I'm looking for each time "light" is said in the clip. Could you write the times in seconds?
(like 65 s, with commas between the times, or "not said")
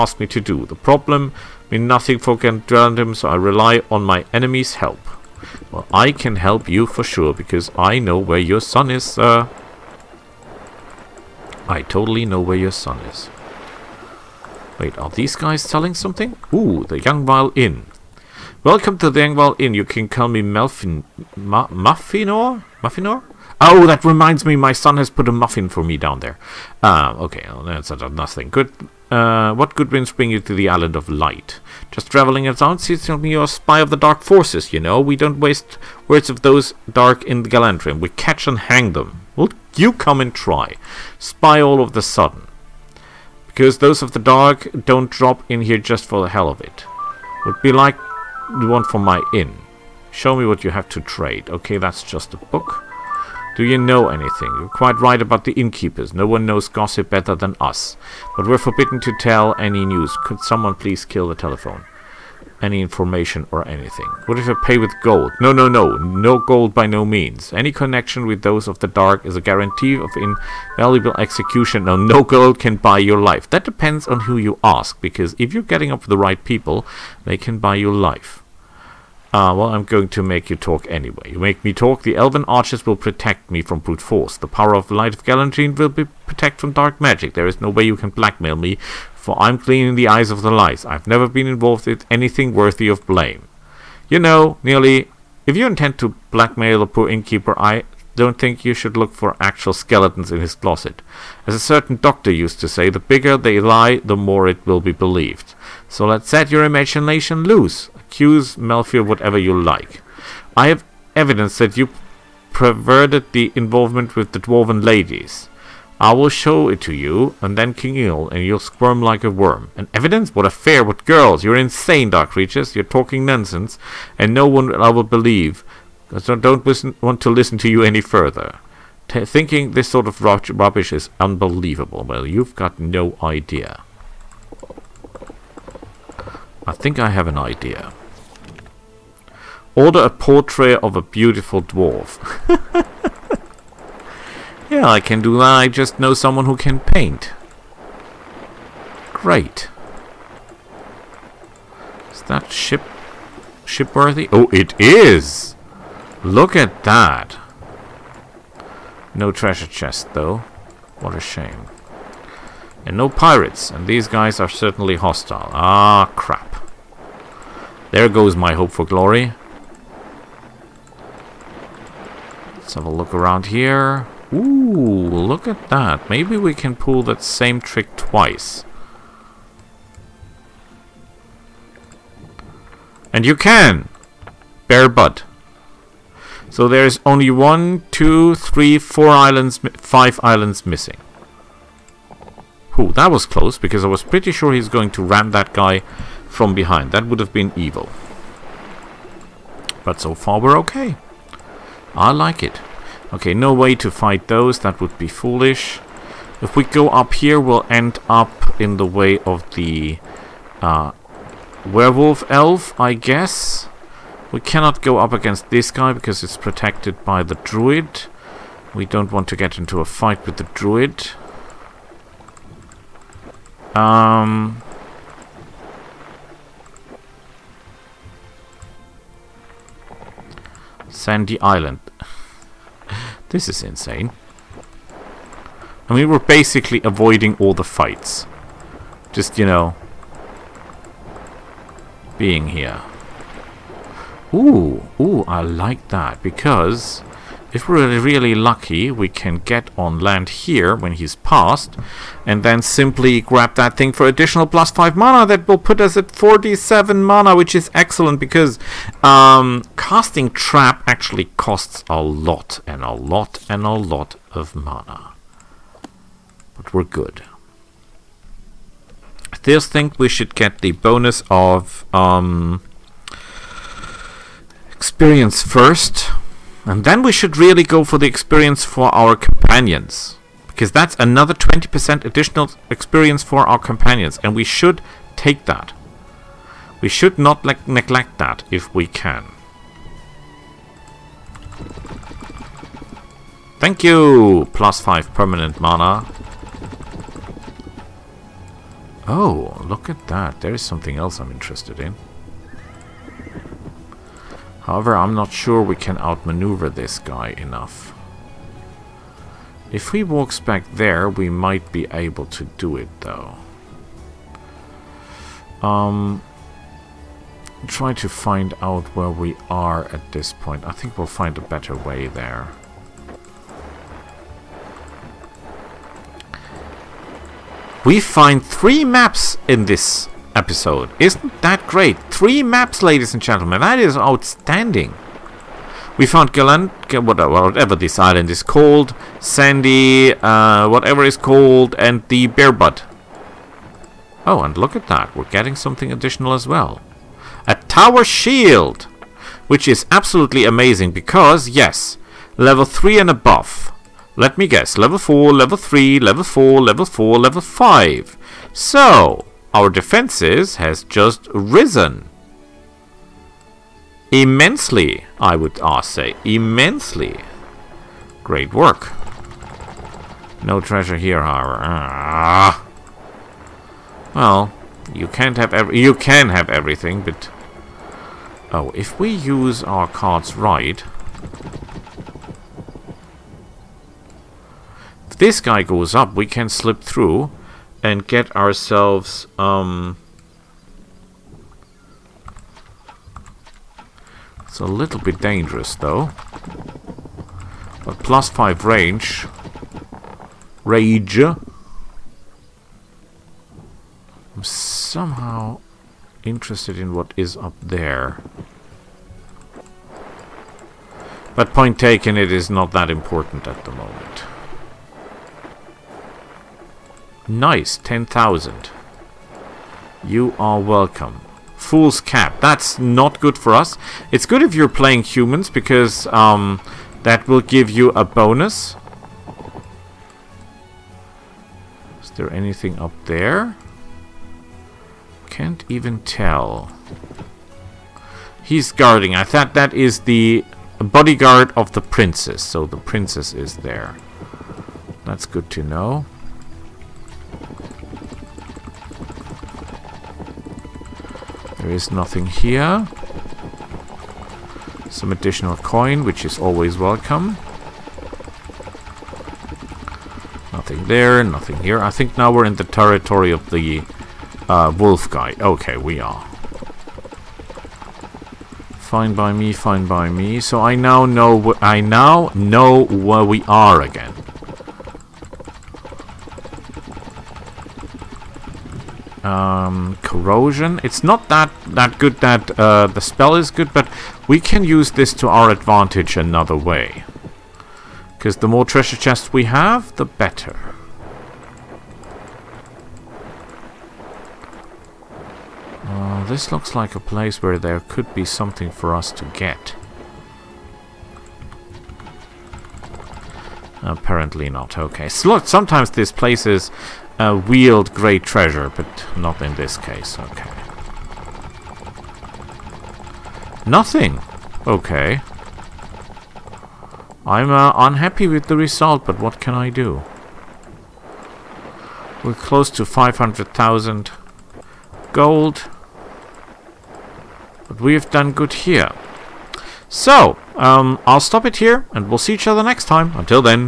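31 s, 84 s, 90 s.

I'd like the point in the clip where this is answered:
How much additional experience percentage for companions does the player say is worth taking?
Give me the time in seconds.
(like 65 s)
281 s.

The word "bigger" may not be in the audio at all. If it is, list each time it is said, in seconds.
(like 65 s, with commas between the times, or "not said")
102 s.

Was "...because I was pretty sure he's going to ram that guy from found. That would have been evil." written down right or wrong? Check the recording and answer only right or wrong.
wrong.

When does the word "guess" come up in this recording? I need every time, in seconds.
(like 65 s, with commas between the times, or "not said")
212 s, 354 s.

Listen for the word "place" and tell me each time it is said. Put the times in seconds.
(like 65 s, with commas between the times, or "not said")
496 s, 506 s.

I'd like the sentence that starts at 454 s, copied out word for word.
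Some additional coin, which is always welcome.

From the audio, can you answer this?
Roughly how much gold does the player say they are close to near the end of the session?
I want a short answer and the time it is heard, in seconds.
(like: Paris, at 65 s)
500,000, at 522 s.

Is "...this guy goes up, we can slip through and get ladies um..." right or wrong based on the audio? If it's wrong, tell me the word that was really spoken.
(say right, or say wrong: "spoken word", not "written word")
wrong: "ourselves", not "ladies".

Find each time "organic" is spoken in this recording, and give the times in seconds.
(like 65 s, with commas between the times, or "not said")
not said.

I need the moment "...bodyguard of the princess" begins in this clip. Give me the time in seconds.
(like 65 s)
440 s.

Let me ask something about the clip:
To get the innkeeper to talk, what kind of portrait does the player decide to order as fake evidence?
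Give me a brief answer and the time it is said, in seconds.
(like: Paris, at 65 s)
A beautiful dwarf, at 140 s.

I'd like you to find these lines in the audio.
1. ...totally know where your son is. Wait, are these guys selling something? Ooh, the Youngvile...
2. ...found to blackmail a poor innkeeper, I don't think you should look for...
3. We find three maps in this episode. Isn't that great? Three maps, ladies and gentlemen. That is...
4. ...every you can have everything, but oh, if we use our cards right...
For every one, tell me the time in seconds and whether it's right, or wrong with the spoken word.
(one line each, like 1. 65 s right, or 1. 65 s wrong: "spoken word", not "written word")
1. 11 s right
2. 95 s wrong: "intend", not "found"
3. 327 s right
4. 375 s right.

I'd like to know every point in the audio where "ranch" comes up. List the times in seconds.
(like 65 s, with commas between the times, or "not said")
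not said.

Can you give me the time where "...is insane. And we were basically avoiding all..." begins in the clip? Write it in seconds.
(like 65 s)
233 s.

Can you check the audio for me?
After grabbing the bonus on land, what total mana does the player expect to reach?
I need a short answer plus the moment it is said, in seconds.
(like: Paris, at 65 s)
47, at 256 s.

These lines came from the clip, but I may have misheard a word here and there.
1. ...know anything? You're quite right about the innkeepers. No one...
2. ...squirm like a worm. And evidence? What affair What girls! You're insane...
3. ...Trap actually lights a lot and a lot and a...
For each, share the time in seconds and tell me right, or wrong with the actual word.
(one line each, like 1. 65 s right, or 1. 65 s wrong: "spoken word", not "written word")
1. 53 s right
2. 118 s right
3. 260 s wrong: "costs", not "lights".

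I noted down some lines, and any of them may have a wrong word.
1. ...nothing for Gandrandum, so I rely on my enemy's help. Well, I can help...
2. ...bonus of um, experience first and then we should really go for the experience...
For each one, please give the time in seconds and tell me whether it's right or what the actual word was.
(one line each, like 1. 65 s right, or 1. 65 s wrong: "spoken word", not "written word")
1. 1 s right
2. 270 s right.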